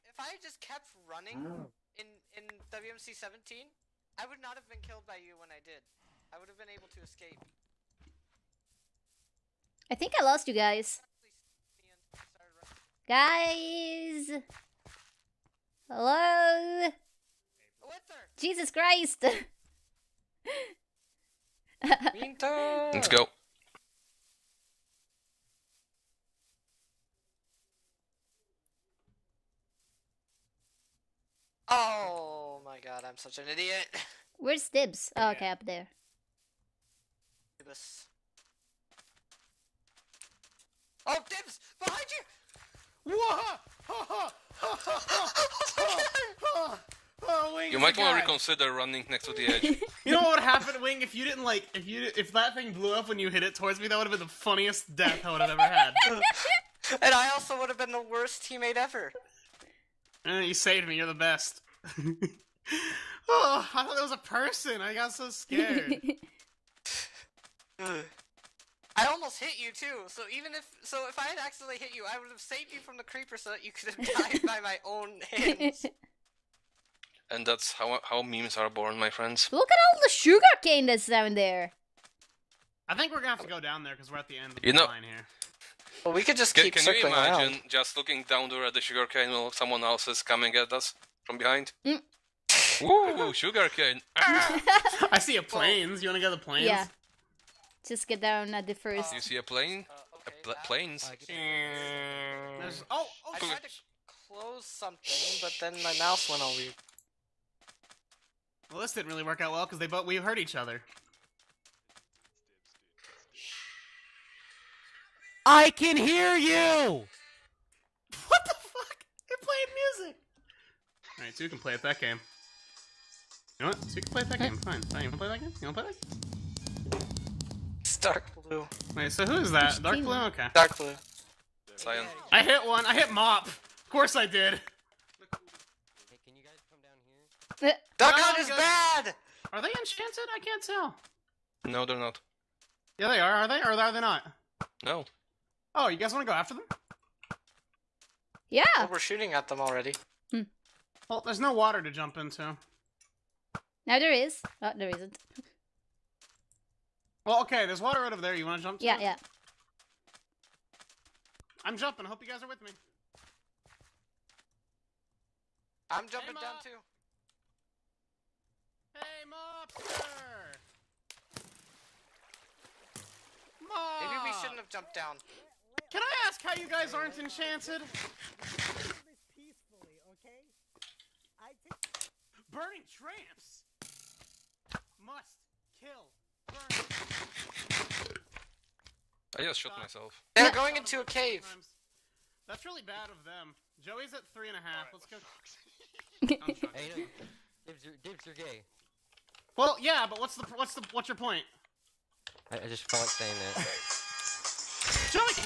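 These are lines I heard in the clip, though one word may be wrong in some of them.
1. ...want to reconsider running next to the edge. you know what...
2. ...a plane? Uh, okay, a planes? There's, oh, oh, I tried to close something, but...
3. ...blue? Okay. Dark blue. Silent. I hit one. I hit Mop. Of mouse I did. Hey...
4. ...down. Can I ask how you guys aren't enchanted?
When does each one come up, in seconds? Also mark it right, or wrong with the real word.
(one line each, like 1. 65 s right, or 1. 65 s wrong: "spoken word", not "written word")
1. 47 s right
2. 99 s right
3. 130 s wrong: "course", not "mouse"
4. 174 s right.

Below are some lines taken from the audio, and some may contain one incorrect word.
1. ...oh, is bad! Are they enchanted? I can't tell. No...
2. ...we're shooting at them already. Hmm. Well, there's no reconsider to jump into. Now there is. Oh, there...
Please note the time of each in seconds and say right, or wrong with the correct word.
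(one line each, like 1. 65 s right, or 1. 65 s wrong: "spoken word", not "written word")
1. 138 s right
2. 148 s wrong: "water", not "reconsider".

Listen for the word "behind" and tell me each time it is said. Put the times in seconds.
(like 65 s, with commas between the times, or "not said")
41 s, 91 s.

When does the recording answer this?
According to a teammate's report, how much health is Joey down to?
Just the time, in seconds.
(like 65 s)
194 s.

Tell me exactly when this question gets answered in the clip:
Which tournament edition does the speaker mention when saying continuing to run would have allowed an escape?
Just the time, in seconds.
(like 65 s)
2 s.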